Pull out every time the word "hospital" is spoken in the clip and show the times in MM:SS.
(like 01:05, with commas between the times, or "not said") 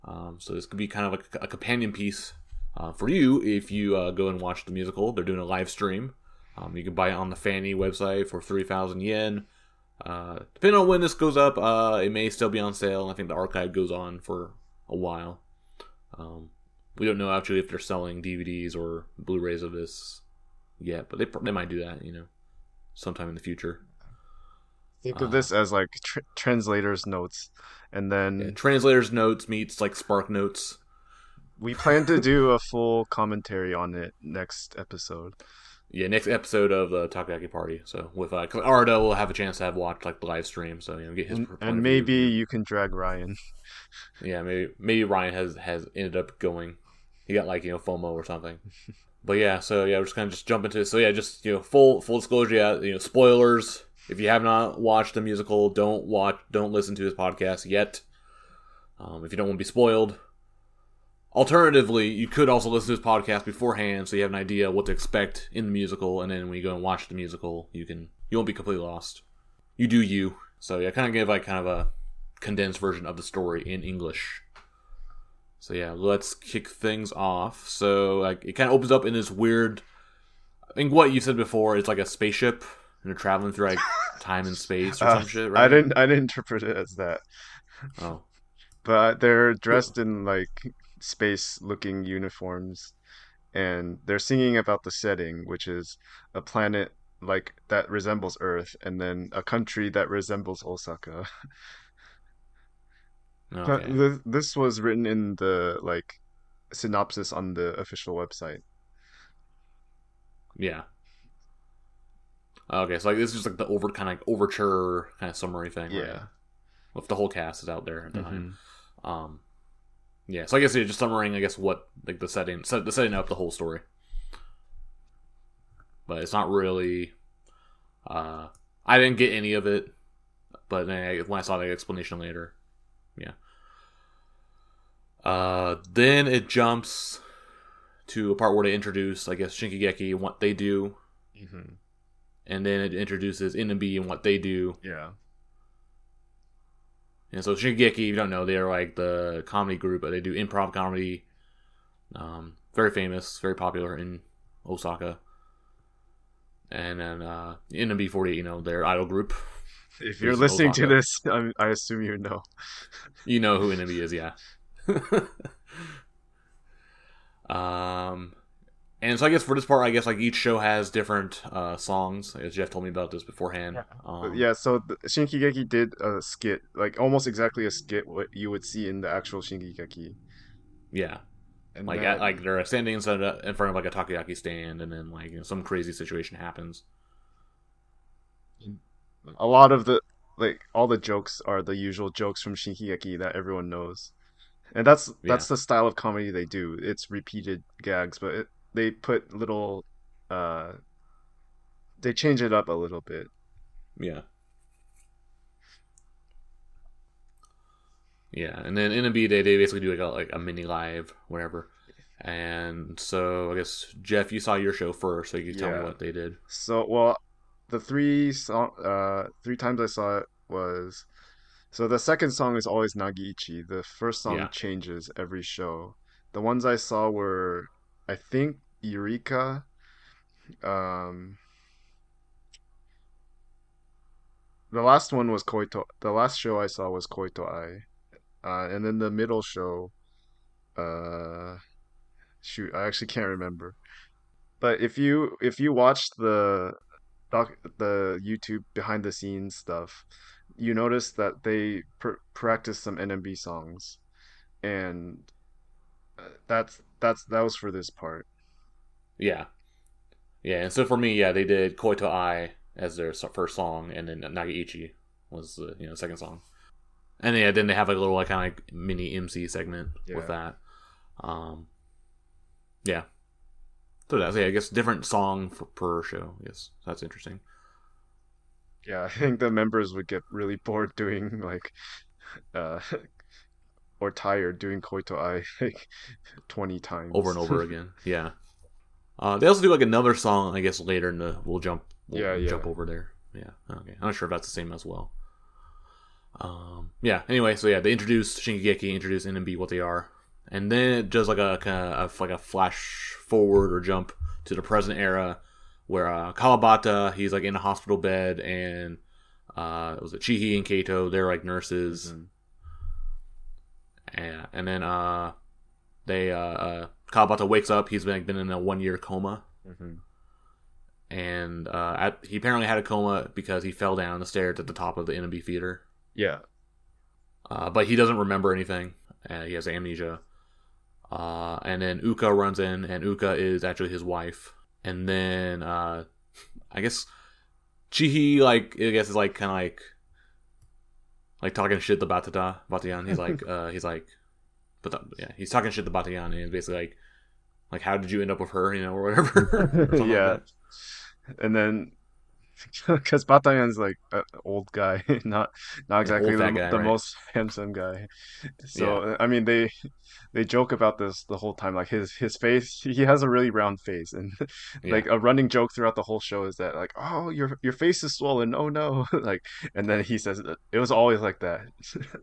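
05:07.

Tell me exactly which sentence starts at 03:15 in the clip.
the style of comedy they do.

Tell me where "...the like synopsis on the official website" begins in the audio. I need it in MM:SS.
01:45.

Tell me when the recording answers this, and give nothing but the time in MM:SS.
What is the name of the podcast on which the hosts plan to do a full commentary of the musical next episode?
00:37.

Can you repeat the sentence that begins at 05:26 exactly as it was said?
Yeah, uh, but he doesn't remember anything.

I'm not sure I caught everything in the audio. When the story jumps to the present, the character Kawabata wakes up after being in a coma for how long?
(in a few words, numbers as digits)
1 year.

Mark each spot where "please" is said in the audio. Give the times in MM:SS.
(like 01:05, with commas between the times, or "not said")
not said.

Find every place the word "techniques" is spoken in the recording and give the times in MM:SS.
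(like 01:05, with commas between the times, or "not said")
not said.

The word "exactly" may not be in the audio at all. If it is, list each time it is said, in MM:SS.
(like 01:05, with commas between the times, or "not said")
02:57, 05:56.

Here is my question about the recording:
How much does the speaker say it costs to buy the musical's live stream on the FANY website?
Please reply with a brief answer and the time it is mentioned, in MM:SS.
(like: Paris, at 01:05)
3,000 yen, at 00:08.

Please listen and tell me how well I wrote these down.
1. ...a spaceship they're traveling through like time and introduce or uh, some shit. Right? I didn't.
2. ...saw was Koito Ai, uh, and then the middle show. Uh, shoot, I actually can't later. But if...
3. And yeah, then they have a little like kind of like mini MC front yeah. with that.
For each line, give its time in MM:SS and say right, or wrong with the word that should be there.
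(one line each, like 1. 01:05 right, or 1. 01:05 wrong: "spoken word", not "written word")
1. 01:21 wrong: "space", not "introduce"
2. 03:56 wrong: "remember", not "later"
3. 04:27 wrong: "segment", not "front".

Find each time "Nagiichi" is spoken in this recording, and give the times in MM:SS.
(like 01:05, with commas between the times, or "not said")
03:42, 04:24.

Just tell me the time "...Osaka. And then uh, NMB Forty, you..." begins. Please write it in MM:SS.
02:34.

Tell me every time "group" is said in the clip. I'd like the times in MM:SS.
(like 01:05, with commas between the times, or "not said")
02:29, 02:39.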